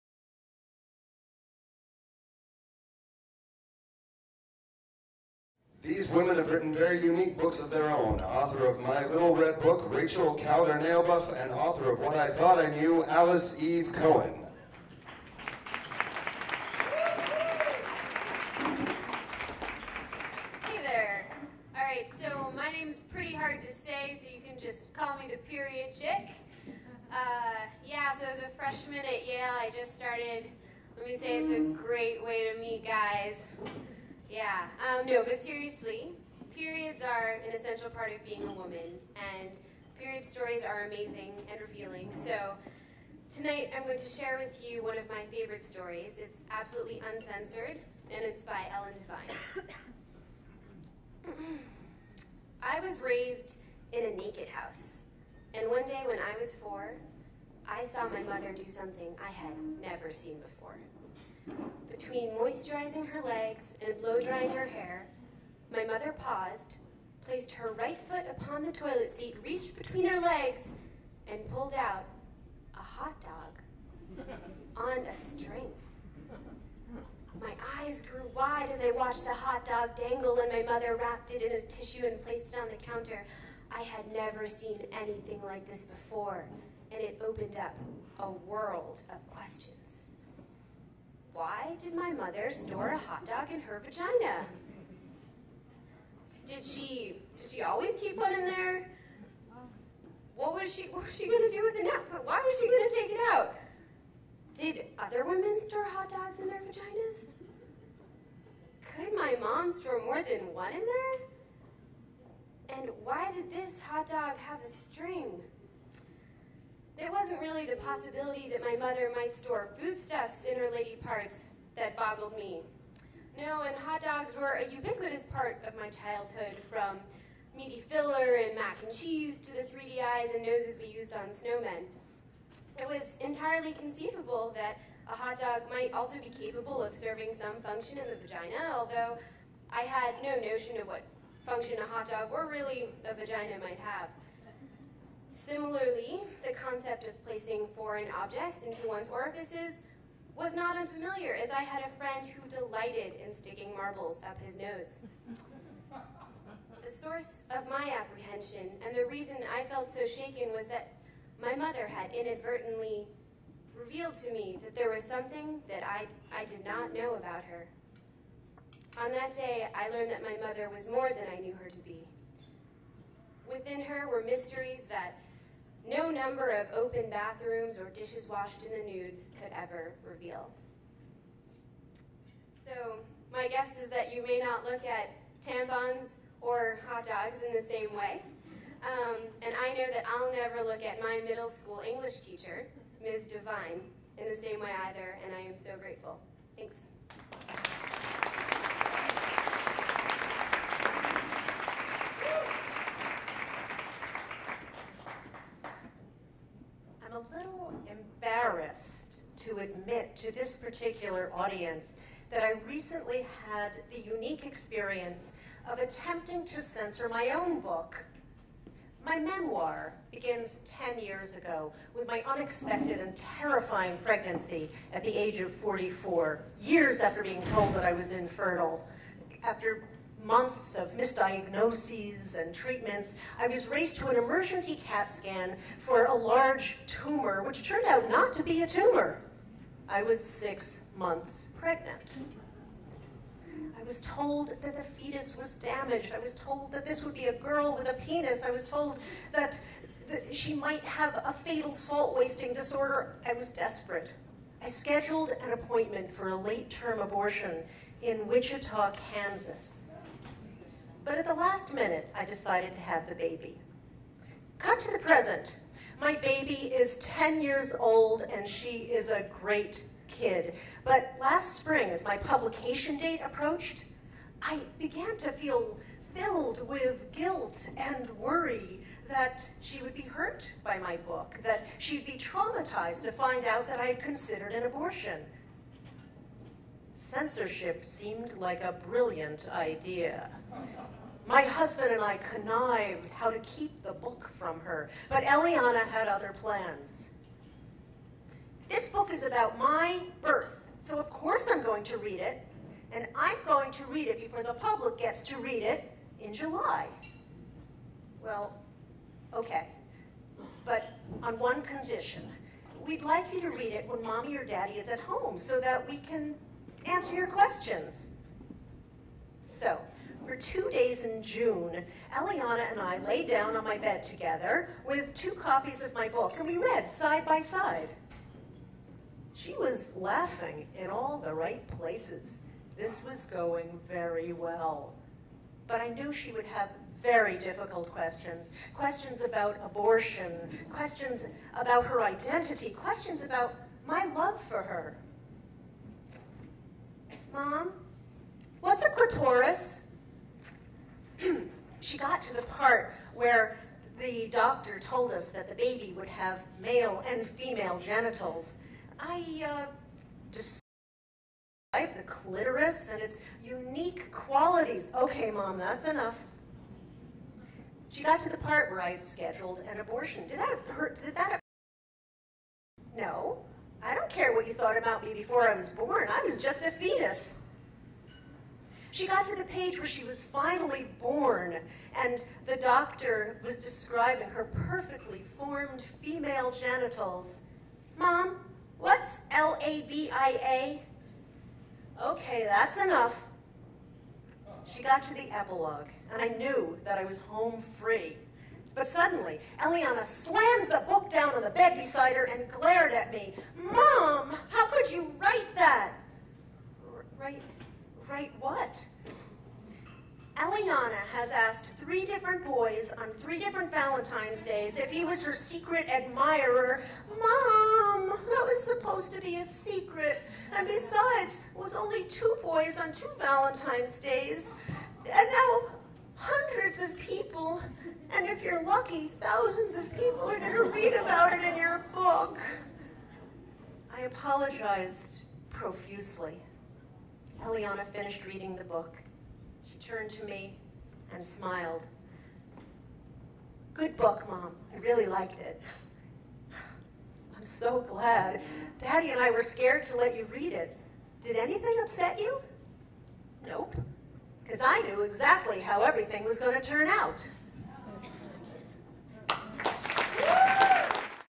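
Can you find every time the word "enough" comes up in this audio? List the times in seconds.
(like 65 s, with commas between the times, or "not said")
365 s, 392 s.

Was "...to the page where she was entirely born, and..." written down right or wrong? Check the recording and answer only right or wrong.
wrong.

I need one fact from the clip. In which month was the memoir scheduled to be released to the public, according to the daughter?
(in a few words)
July.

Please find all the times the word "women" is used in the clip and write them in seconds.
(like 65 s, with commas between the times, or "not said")
6 s, 105 s.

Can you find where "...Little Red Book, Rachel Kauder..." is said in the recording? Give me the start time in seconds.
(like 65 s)
9 s.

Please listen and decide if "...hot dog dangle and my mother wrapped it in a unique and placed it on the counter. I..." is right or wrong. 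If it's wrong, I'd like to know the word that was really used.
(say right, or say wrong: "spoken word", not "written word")
wrong: "tissue", not "unique".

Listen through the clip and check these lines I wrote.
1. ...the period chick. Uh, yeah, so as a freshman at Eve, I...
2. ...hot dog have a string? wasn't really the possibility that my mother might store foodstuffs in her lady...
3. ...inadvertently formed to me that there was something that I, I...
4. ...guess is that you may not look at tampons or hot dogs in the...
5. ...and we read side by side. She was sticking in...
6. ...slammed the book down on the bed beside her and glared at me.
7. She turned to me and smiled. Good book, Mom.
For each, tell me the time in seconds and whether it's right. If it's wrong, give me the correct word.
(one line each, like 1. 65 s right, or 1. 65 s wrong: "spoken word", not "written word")
1. 25 s wrong: "Yale", not "Eve"
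2. 113 s right
3. 162 s wrong: "revealed", not "formed"
4. 183 s right
5. 326 s wrong: "laughing", not "sticking"
6. 400 s right
7. 439 s right.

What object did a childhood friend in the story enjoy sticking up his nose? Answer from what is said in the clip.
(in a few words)
marbles.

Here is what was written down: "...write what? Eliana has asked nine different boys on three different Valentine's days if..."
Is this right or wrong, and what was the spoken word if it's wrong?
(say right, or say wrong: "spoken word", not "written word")
wrong: "three", not "nine".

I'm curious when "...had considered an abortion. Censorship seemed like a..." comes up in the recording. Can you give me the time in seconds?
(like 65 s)
283 s.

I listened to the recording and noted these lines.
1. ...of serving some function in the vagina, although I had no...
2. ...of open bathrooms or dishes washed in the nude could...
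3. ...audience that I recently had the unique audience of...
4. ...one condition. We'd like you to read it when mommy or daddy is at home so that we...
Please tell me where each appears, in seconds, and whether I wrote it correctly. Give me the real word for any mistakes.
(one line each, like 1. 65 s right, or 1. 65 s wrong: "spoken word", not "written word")
1. 136 s right
2. 176 s right
3. 211 s wrong: "experience", not "audience"
4. 311 s right.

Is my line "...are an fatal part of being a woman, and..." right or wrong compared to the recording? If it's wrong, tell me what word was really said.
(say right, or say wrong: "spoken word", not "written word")
wrong: "essential", not "fatal".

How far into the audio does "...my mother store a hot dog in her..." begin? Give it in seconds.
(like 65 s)
91 s.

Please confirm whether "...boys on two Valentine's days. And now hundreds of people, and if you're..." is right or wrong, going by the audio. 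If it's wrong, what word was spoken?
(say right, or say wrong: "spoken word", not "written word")
right.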